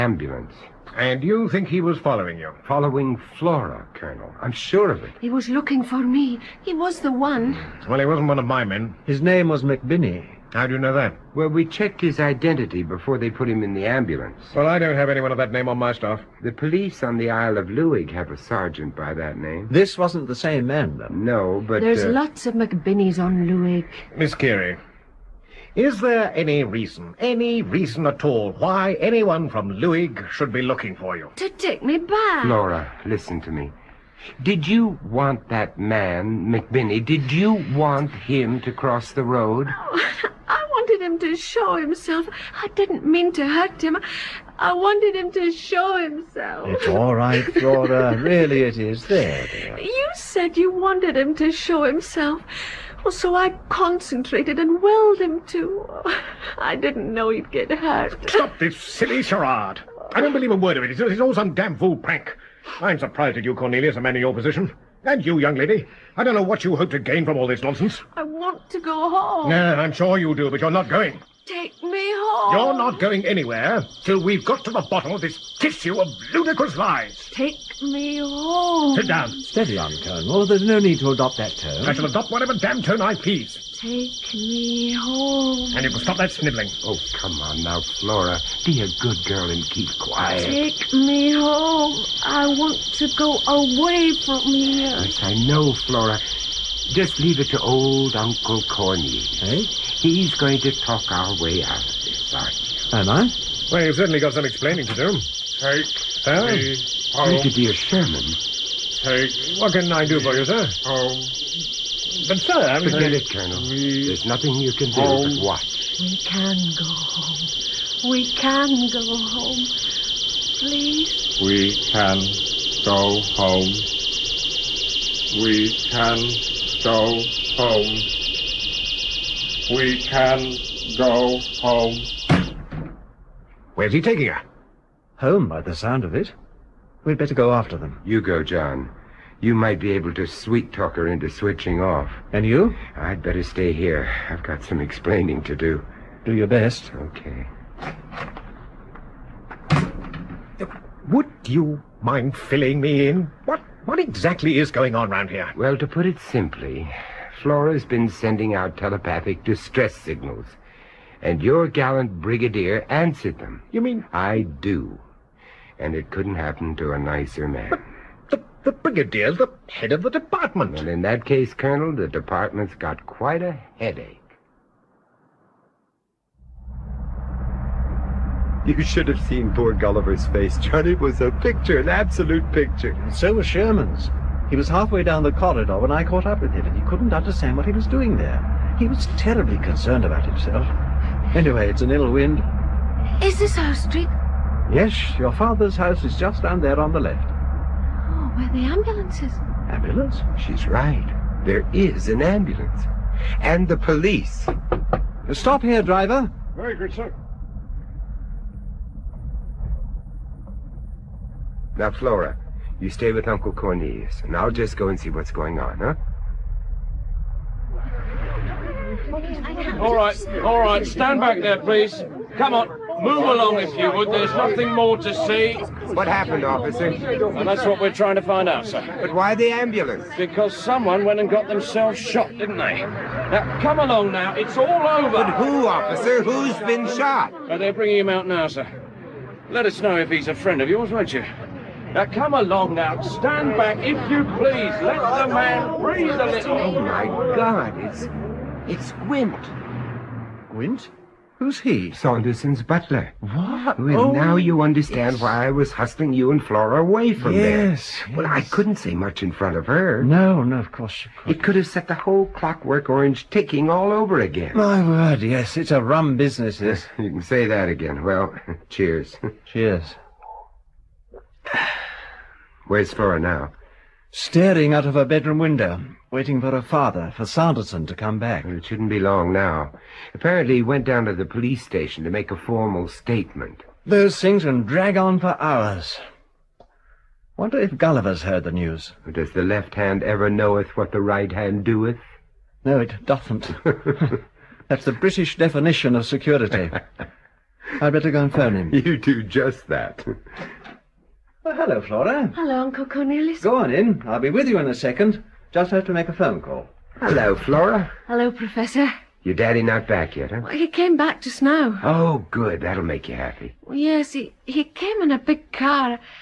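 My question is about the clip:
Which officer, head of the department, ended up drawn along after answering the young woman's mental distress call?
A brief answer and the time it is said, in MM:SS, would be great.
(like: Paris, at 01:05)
Brigadier Sherman, at 01:47.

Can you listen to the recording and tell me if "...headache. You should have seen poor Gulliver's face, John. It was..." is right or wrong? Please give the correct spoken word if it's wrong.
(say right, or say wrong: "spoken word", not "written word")
right.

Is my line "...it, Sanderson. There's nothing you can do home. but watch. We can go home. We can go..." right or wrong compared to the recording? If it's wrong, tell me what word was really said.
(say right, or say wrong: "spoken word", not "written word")
wrong: "Colonel", not "Sanderson".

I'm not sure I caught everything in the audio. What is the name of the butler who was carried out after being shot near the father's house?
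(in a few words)
Gwent.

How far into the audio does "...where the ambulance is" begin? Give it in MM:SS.
03:18.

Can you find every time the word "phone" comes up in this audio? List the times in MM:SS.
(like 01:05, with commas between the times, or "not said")
04:58, 05:06.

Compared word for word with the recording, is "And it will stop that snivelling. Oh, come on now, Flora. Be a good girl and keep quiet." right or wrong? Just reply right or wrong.
right.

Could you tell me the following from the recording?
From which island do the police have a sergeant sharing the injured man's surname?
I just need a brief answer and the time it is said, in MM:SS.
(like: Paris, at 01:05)
Isle of Luig, at 00:17.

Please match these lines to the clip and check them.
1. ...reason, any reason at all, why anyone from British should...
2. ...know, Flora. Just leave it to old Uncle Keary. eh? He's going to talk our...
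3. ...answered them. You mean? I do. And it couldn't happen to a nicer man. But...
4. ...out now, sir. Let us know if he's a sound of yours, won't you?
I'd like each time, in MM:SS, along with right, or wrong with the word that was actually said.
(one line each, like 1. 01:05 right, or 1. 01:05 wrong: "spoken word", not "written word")
1. 00:26 wrong: "Luig", not "British"
2. 01:35 wrong: "Corny", not "Keary"
3. 02:42 right
4. 03:58 wrong: "friend", not "sound".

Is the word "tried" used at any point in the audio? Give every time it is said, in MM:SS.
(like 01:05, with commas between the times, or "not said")
not said.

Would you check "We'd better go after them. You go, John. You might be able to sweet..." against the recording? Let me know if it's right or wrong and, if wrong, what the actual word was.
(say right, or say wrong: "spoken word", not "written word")
right.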